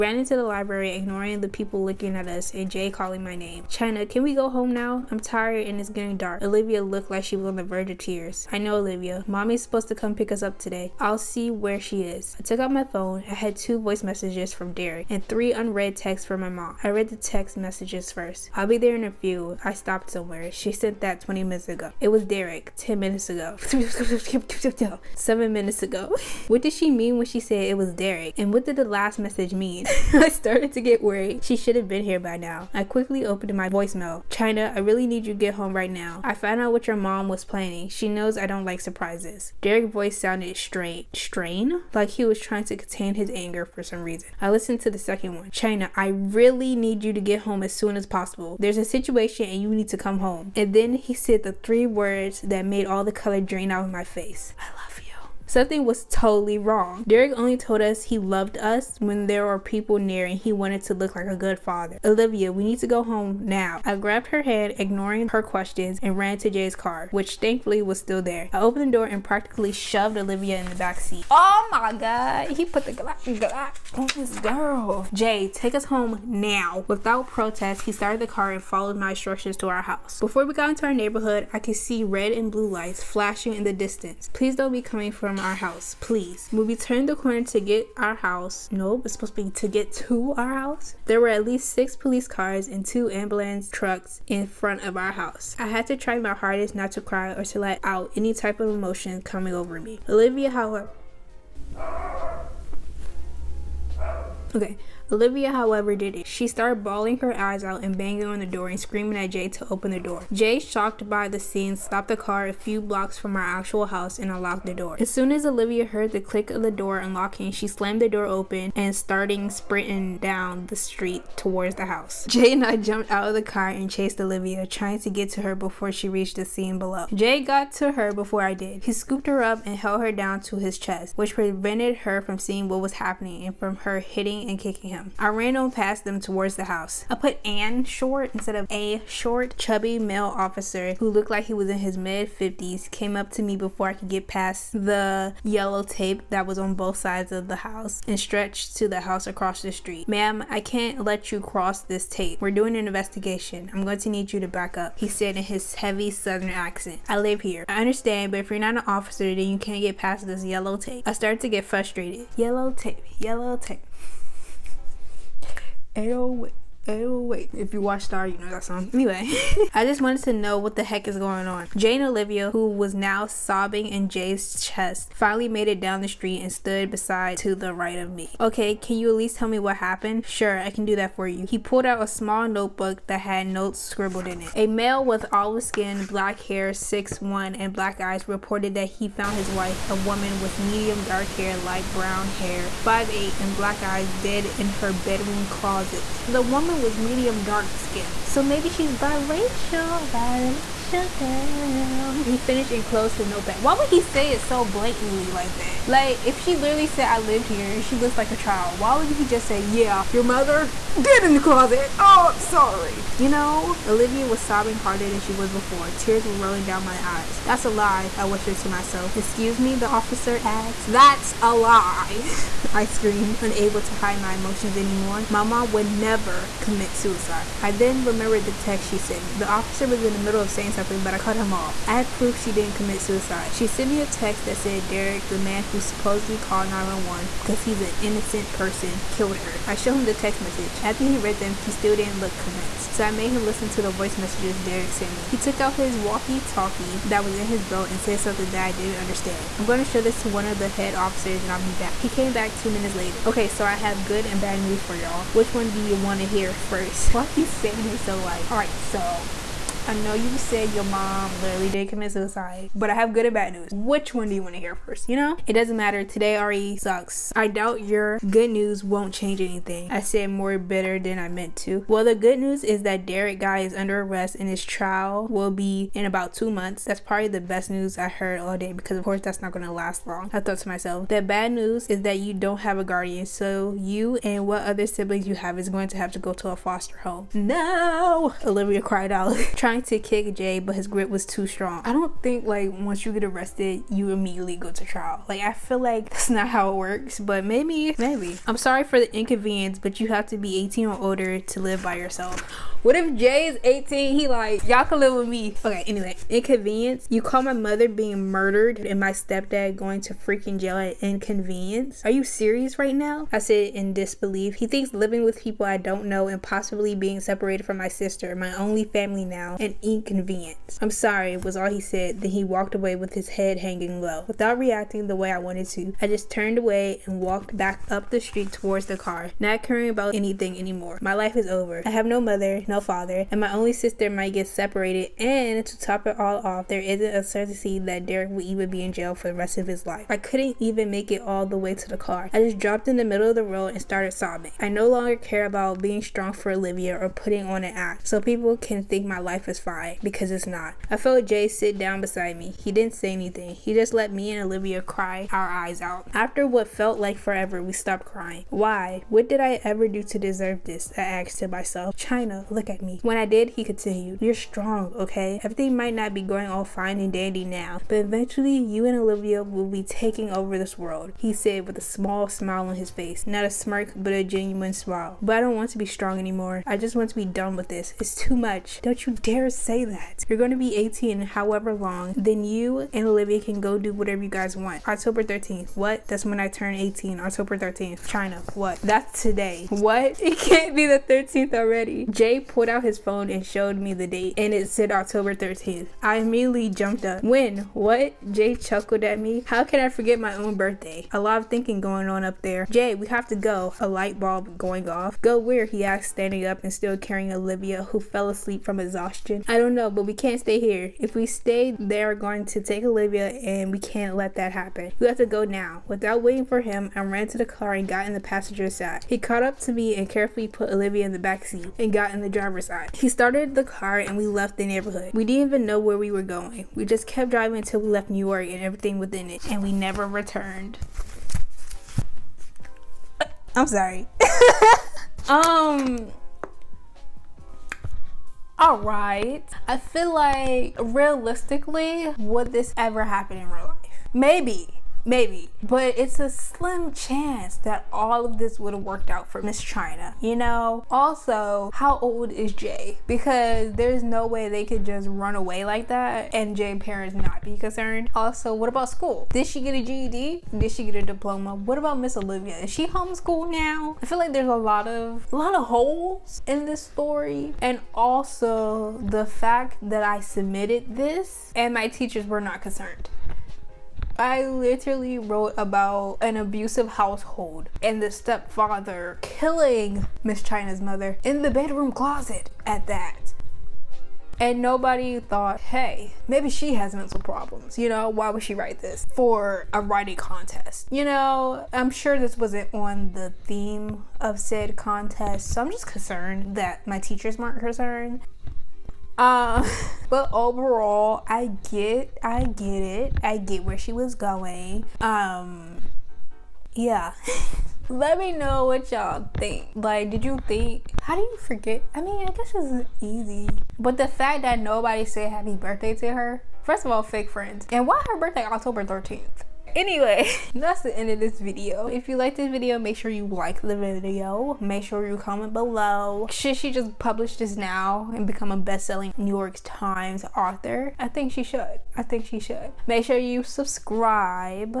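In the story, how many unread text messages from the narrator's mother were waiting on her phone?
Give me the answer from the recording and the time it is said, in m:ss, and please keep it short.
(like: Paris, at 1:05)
3, at 0:15.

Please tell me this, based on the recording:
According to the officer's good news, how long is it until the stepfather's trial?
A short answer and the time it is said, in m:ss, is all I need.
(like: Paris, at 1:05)
About 2 months, at 4:36.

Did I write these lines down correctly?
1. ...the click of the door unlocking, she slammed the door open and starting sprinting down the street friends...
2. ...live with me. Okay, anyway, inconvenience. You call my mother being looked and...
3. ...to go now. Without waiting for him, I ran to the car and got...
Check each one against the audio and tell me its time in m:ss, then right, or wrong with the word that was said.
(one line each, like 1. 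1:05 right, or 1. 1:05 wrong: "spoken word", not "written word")
1. 1:56 wrong: "towards", not "friends"
2. 5:04 wrong: "murdered", not "looked"
3. 6:55 right.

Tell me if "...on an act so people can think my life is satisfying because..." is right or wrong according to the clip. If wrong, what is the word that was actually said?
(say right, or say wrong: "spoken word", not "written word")
right.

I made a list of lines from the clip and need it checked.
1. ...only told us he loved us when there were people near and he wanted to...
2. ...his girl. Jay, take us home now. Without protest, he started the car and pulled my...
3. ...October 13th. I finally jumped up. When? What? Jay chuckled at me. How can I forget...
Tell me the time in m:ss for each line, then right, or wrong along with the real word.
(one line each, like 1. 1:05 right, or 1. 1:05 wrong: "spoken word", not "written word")
1. 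0:57 right
2. 1:14 wrong: "followed", not "pulled"
3. 6:34 wrong: "immediately", not "finally".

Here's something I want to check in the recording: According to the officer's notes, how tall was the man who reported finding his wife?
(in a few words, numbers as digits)
6'1.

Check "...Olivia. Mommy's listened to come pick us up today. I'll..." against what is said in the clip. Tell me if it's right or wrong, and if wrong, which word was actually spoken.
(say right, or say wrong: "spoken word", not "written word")
wrong: "supposed", not "listened".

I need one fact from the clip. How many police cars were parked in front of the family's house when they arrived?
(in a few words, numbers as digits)
6.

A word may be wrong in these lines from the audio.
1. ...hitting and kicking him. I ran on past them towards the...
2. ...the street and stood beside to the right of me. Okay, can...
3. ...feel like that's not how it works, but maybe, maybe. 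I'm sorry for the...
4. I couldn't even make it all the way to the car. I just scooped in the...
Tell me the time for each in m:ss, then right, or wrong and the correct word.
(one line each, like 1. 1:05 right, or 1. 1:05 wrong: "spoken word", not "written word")
1. 2:13 right
2. 2:56 right
3. 4:55 right
4. 5:40 wrong: "dropped", not "scooped".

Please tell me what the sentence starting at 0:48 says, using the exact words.
There's a situation and you need to come home.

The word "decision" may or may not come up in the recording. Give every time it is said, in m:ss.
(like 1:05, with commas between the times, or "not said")
not said.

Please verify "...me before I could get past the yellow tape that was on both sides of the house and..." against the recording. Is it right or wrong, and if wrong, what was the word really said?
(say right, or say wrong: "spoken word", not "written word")
right.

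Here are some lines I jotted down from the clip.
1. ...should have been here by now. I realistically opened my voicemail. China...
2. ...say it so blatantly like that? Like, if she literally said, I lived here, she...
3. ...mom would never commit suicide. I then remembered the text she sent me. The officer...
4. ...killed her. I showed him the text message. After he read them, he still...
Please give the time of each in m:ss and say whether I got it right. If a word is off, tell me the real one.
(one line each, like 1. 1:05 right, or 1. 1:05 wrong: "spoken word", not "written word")
1. 0:31 wrong: "quickly", not "realistically"
2. 3:24 right
3. 3:45 right
4. 3:59 right.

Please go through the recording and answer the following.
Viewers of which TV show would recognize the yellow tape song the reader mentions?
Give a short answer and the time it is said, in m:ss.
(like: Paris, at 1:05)
Star, at 2:48.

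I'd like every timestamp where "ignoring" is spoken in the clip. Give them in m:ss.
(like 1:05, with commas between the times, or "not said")
0:00, 1:04.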